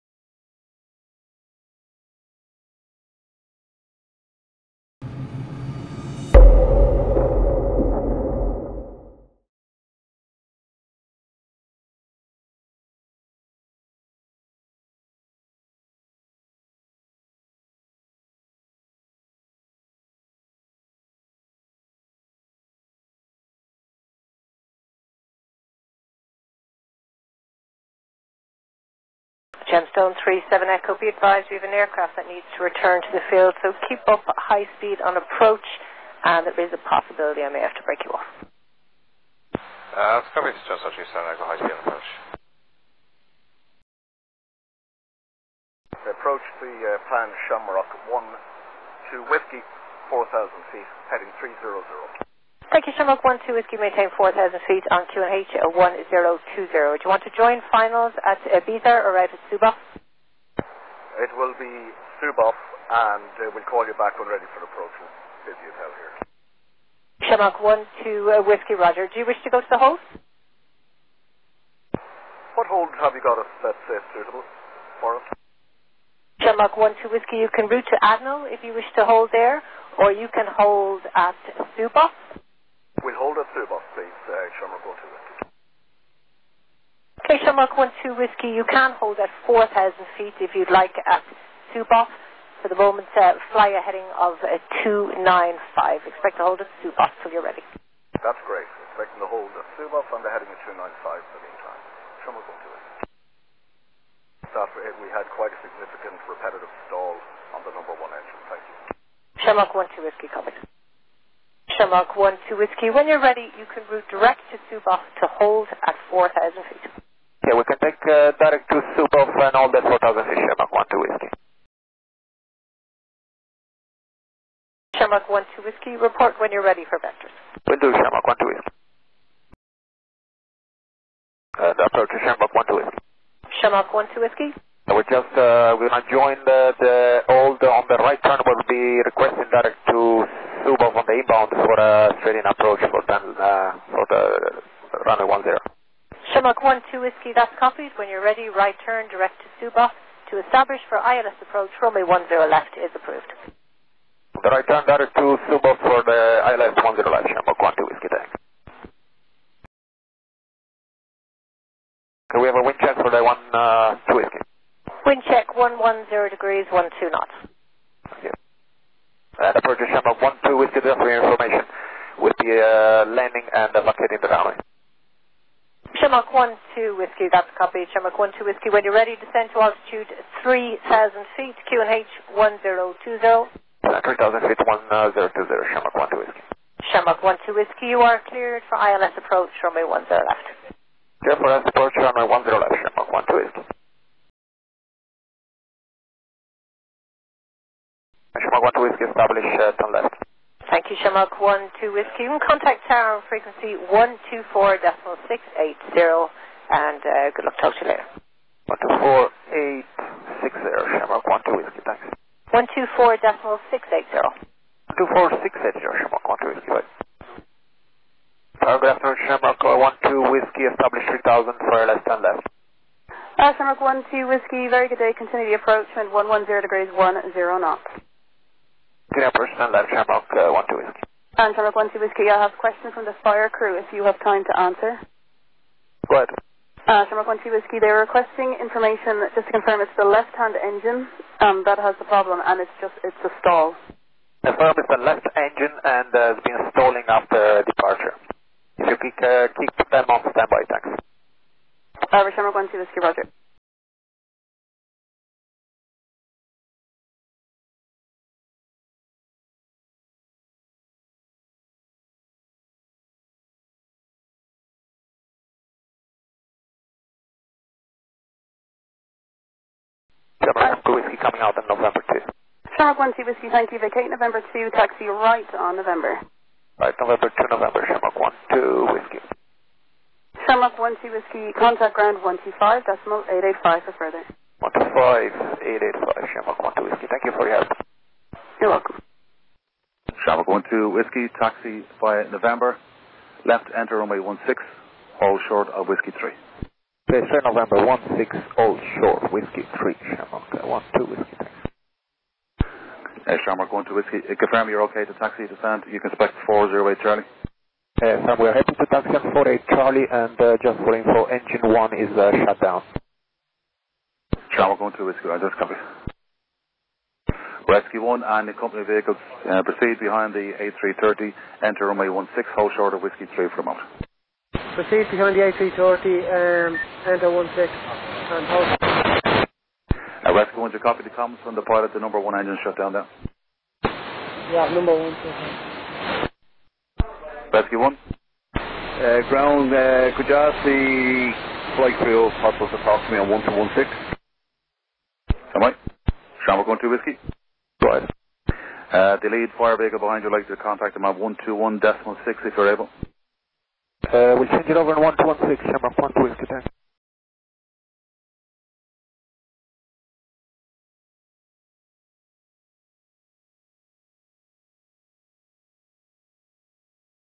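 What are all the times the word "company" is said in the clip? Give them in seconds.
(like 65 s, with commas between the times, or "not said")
318 s.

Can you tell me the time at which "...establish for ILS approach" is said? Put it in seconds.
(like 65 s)
150 s.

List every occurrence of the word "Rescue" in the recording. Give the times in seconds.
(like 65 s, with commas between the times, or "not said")
317 s, 330 s, 337 s.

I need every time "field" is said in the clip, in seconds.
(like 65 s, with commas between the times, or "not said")
33 s.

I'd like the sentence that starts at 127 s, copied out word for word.
Will do, Shamrock 1 2 Whiskey.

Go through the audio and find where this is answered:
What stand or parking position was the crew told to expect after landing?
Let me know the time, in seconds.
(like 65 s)
306 s.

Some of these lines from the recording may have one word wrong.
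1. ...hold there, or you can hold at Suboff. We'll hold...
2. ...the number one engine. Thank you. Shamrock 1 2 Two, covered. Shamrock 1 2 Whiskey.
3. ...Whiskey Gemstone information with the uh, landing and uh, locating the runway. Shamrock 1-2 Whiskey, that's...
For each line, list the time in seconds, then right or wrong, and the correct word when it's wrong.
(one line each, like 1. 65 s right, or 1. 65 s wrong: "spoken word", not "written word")
1. 79 s right
2. 107 s wrong: "Whiskey", not "Two"
3. 170 s wrong: "Delta", not "Gemstone".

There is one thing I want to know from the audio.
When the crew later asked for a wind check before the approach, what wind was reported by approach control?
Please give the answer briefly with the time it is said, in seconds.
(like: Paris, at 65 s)
110 degrees, 12 knots, at 165 s.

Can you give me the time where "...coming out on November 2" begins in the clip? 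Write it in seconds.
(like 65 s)
271 s.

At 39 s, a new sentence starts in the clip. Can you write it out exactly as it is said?
Uh, let's copy this Gemstone 37 Echo, high speed on approach.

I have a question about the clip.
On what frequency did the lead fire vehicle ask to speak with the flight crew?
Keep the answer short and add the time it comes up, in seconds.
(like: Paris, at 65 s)
121.6, at 351 s.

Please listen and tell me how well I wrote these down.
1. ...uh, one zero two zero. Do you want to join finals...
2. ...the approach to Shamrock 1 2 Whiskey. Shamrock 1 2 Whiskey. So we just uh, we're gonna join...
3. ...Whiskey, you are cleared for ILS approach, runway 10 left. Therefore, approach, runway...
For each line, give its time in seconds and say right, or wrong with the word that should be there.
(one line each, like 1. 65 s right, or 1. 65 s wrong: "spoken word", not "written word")
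1. 55 s right
2. 131 s right
3. 187 s right.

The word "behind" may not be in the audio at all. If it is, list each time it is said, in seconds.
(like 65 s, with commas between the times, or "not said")
320 s, 325 s, 349 s.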